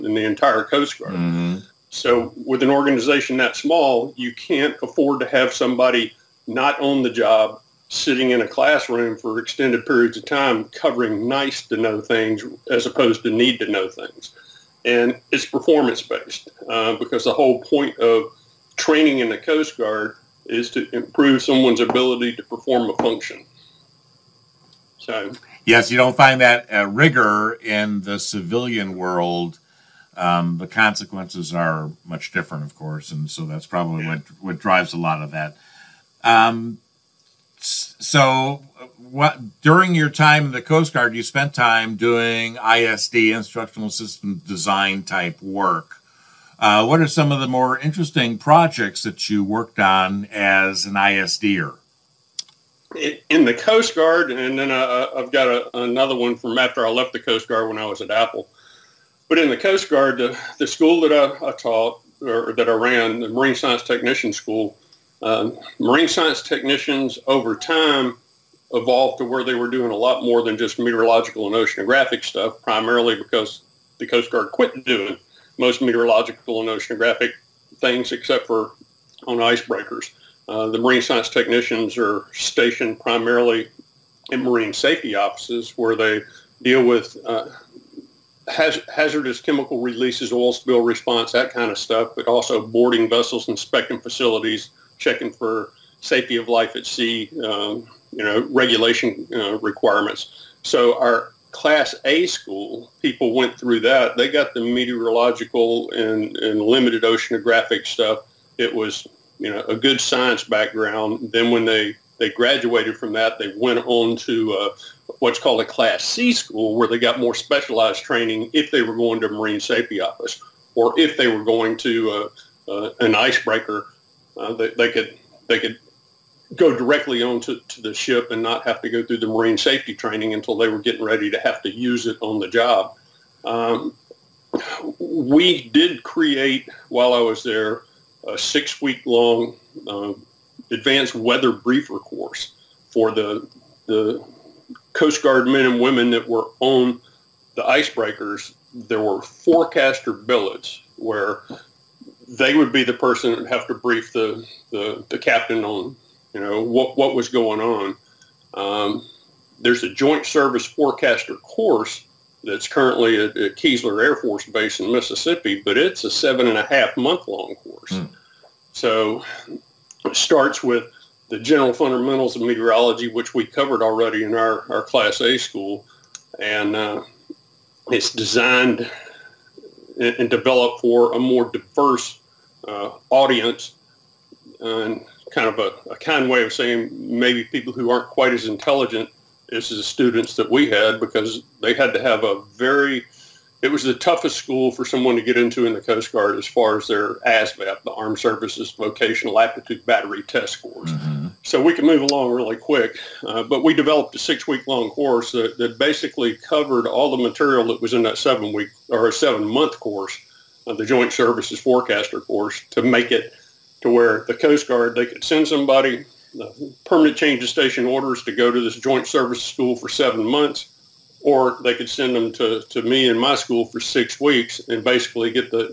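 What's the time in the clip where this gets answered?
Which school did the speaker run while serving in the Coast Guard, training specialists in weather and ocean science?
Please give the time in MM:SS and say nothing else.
01:03.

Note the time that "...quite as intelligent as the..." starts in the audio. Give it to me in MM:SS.
03:08.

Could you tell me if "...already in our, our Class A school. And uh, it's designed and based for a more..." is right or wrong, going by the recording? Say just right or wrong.
wrong.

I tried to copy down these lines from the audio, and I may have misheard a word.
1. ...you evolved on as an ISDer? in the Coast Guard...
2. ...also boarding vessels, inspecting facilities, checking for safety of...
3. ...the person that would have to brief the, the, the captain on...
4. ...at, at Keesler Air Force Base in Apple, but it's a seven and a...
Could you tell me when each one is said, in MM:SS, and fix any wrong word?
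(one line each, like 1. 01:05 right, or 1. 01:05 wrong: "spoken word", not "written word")
1. 00:49 wrong: "worked", not "evolved"
2. 01:32 right
3. 02:32 right
4. 02:43 wrong: "Mississippi", not "Apple".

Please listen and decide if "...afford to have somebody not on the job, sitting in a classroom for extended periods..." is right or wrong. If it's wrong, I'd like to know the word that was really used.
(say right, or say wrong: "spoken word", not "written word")
right.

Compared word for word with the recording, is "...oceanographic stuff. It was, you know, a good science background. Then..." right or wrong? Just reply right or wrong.
right.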